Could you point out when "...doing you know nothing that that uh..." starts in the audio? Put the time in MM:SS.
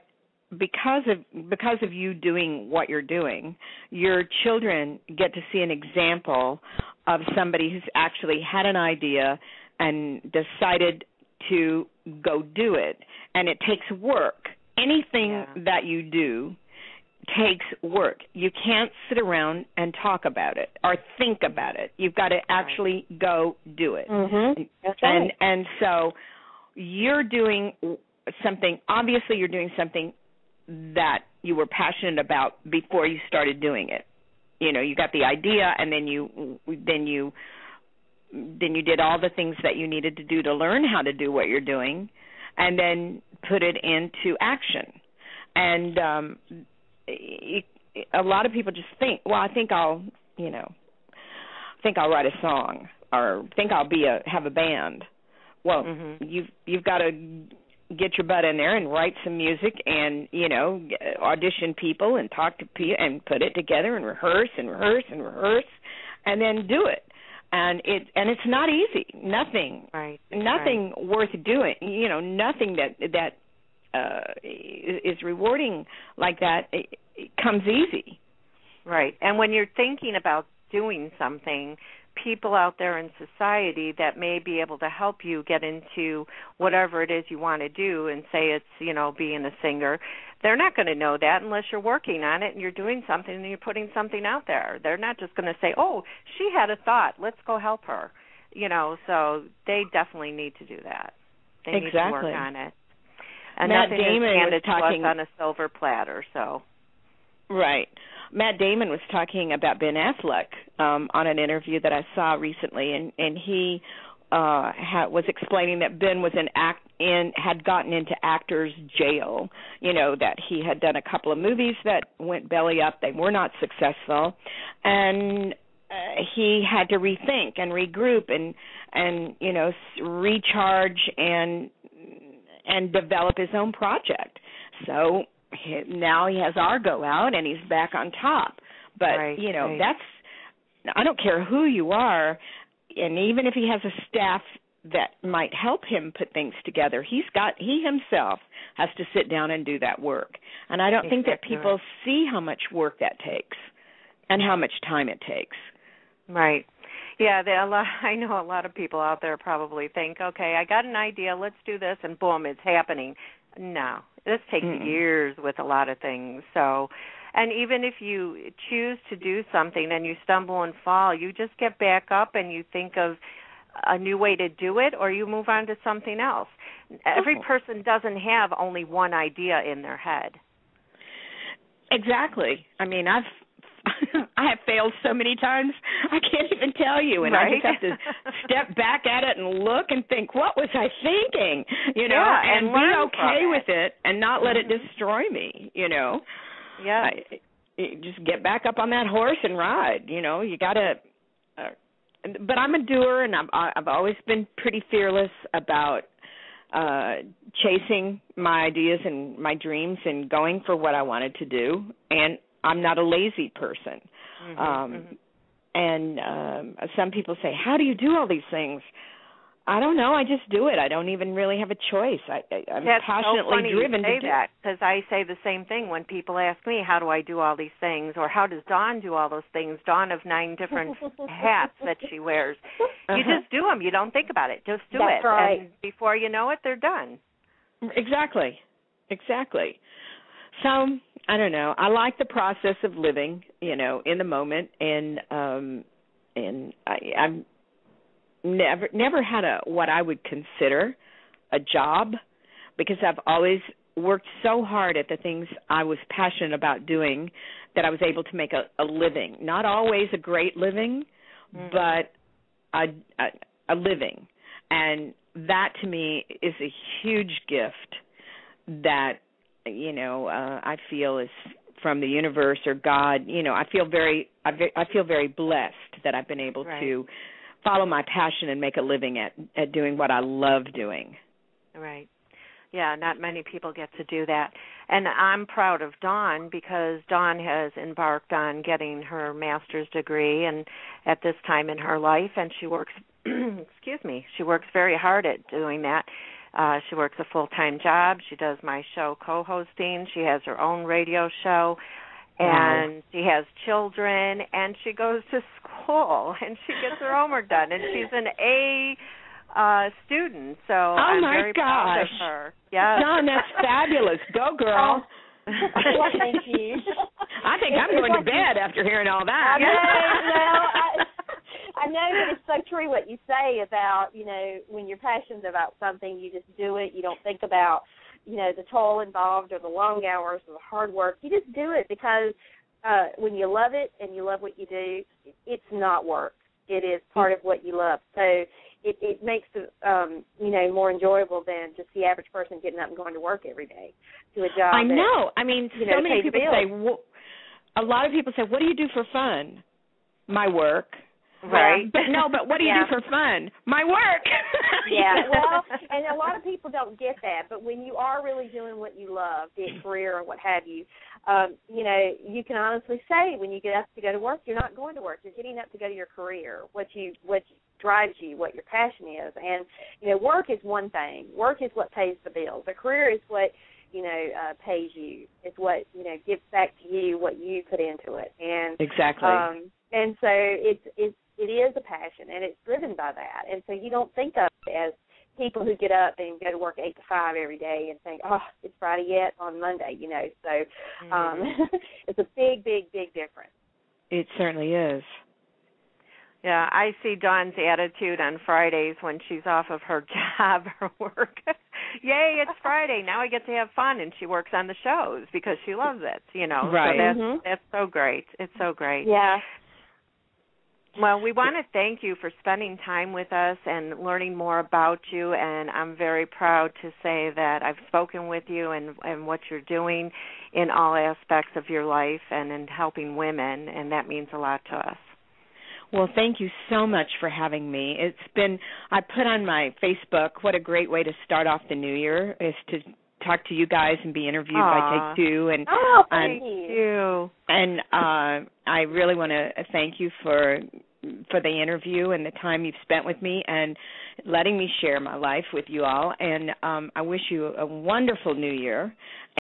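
01:11.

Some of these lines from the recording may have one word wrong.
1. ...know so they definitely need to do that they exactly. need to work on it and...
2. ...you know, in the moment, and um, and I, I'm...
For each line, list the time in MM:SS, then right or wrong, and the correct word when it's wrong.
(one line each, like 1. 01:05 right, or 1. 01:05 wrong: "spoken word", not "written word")
1. 01:38 right
2. 04:03 right.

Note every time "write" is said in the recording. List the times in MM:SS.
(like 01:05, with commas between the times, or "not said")
00:52, 00:58.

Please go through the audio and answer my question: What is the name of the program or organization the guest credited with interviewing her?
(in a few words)
Take Two.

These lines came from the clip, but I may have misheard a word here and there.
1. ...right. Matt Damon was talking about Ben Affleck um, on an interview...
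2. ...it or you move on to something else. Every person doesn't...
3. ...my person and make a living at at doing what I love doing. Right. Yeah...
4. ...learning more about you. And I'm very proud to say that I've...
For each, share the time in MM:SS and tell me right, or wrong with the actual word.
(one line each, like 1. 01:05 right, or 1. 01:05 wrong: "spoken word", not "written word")
1. 01:47 right
2. 02:54 right
3. 04:37 wrong: "passion", not "person"
4. 06:53 right.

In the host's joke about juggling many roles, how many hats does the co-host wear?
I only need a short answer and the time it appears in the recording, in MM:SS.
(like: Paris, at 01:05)
9, at 03:50.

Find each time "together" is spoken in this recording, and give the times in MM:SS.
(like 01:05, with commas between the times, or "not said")
01:03, 02:26.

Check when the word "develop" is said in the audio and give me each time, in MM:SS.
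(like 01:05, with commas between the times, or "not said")
02:12.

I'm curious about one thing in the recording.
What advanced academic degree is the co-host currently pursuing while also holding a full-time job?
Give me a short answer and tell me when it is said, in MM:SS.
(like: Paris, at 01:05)
master's degree, at 04:49.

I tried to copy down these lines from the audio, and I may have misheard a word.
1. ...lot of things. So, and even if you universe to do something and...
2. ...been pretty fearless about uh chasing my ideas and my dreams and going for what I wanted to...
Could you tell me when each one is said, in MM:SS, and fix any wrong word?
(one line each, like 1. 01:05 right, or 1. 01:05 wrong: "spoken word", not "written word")
1. 02:45 wrong: "choose", not "universe"
2. 03:24 right.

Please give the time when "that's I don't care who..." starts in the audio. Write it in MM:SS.
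02:19.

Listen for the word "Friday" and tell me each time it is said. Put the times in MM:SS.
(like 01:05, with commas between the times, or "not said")
06:28, 06:38, 06:42.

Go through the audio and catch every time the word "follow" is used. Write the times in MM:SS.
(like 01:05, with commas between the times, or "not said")
04:37.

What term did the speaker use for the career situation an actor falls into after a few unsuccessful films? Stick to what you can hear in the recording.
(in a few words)
actors jail.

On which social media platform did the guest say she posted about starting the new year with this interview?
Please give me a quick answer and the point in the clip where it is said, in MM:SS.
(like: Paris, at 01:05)
Facebook, at 07:09.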